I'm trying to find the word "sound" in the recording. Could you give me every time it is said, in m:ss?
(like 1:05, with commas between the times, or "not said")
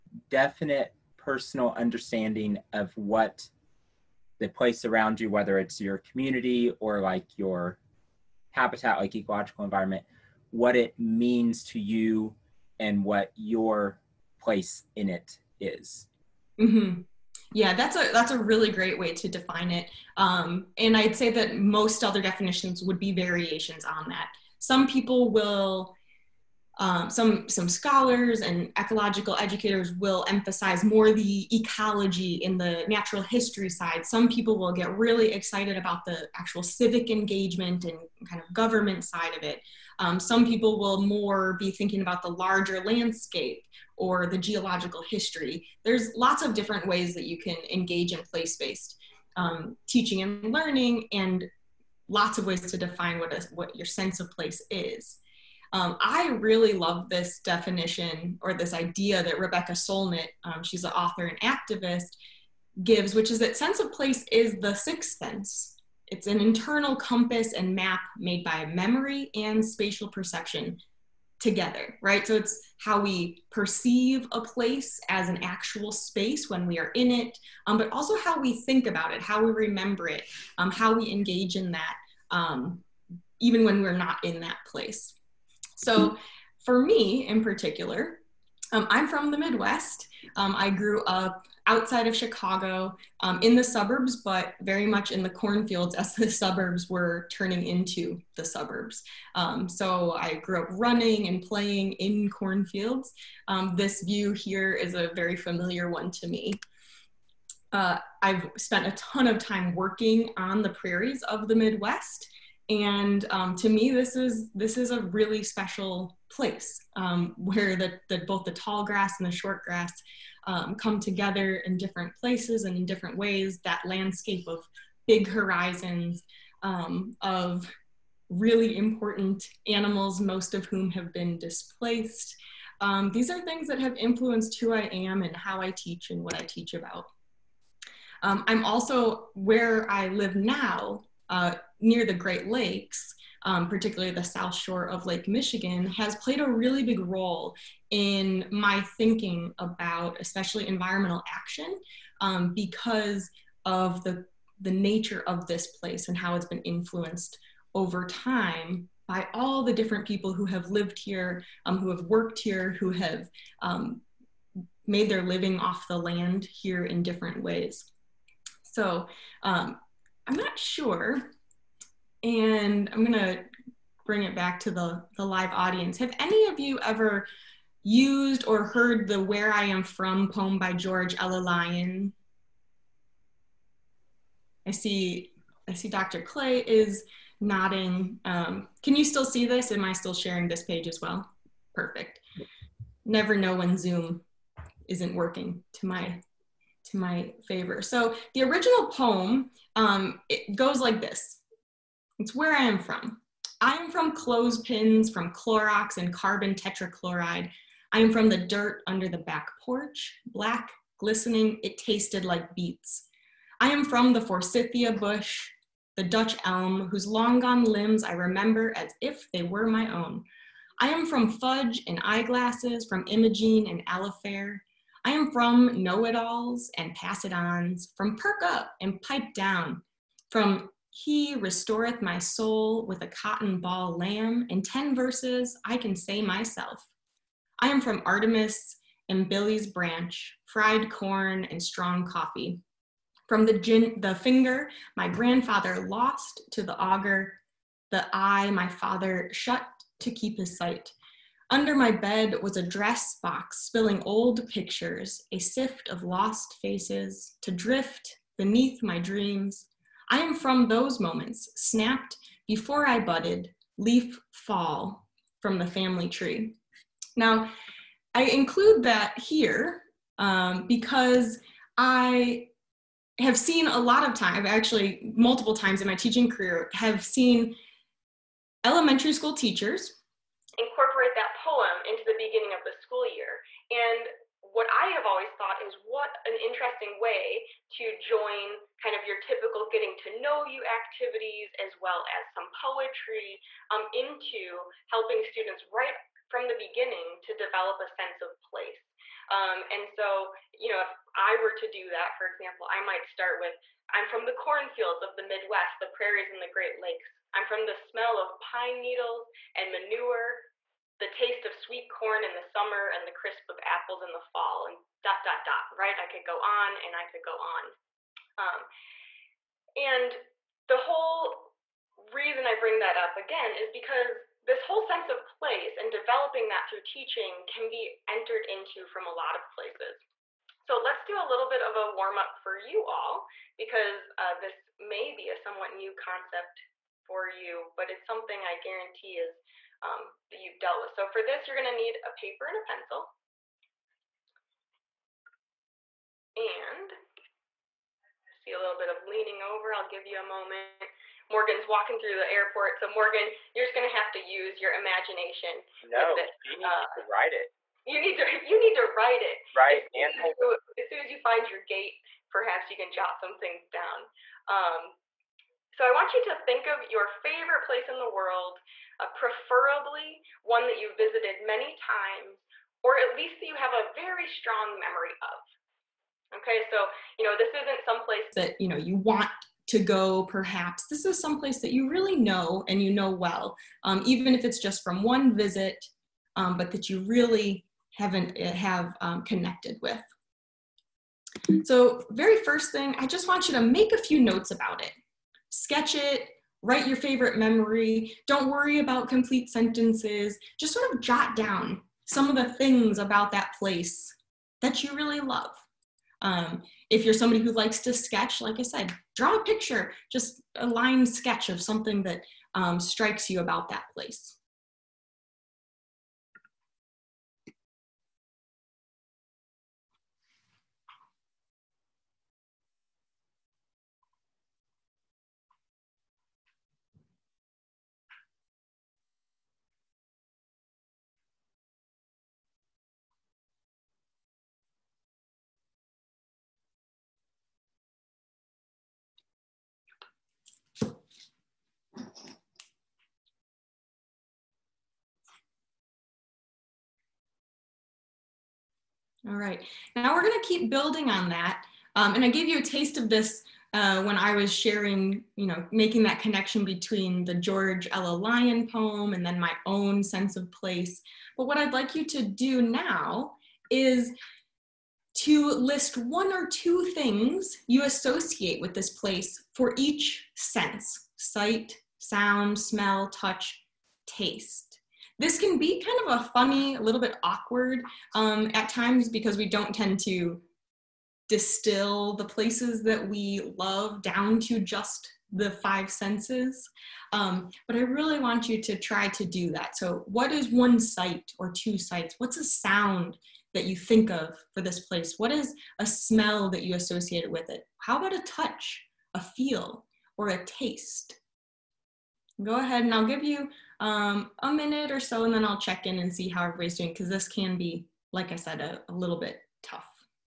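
7:51, 8:12.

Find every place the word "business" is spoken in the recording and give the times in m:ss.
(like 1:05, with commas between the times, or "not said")
not said.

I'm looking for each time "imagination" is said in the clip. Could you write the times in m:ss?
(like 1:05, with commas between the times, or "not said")
5:54.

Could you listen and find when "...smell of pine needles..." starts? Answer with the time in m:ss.
5:07.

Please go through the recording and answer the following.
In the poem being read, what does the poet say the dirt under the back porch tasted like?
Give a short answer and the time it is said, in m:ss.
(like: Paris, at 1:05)
beets, at 3:32.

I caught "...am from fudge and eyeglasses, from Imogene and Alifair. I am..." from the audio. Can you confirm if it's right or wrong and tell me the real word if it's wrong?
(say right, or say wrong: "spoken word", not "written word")
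right.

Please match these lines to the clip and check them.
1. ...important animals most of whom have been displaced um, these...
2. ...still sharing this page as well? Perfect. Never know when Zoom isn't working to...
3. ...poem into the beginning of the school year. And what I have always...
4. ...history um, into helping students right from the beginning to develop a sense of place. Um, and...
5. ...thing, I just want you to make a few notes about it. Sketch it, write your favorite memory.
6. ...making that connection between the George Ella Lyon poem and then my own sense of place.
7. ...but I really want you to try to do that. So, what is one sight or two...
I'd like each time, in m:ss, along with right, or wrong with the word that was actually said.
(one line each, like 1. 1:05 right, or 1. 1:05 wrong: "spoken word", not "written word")
1. 2:08 right
2. 3:09 right
3. 4:41 right
4. 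4:52 wrong: "poetry", not "history"
5. 6:32 right
6. 7:35 right
7. 8:07 right.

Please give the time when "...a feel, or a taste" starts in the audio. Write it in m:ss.
8:19.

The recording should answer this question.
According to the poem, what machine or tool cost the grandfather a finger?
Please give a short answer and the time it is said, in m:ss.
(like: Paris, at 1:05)
the auger, at 4:06.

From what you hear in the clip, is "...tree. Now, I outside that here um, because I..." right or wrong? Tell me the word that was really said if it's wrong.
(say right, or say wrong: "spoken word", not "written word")
wrong: "include", not "outside".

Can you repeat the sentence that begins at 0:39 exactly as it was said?
Um, some people will more be thinking about the larger landscape or the geological history.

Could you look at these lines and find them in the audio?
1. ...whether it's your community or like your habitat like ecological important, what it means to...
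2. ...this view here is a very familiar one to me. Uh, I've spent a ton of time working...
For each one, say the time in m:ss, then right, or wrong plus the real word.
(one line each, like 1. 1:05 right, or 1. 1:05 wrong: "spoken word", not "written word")
1. 0:05 wrong: "environment", not "important"
2. 1:43 right.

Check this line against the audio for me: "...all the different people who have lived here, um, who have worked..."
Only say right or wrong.
right.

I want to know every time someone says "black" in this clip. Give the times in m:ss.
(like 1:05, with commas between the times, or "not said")
3:30.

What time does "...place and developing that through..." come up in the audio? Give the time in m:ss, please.
5:25.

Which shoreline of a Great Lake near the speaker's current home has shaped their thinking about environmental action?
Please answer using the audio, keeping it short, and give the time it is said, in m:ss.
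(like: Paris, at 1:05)
south shore of Lake Michigan, at 2:24.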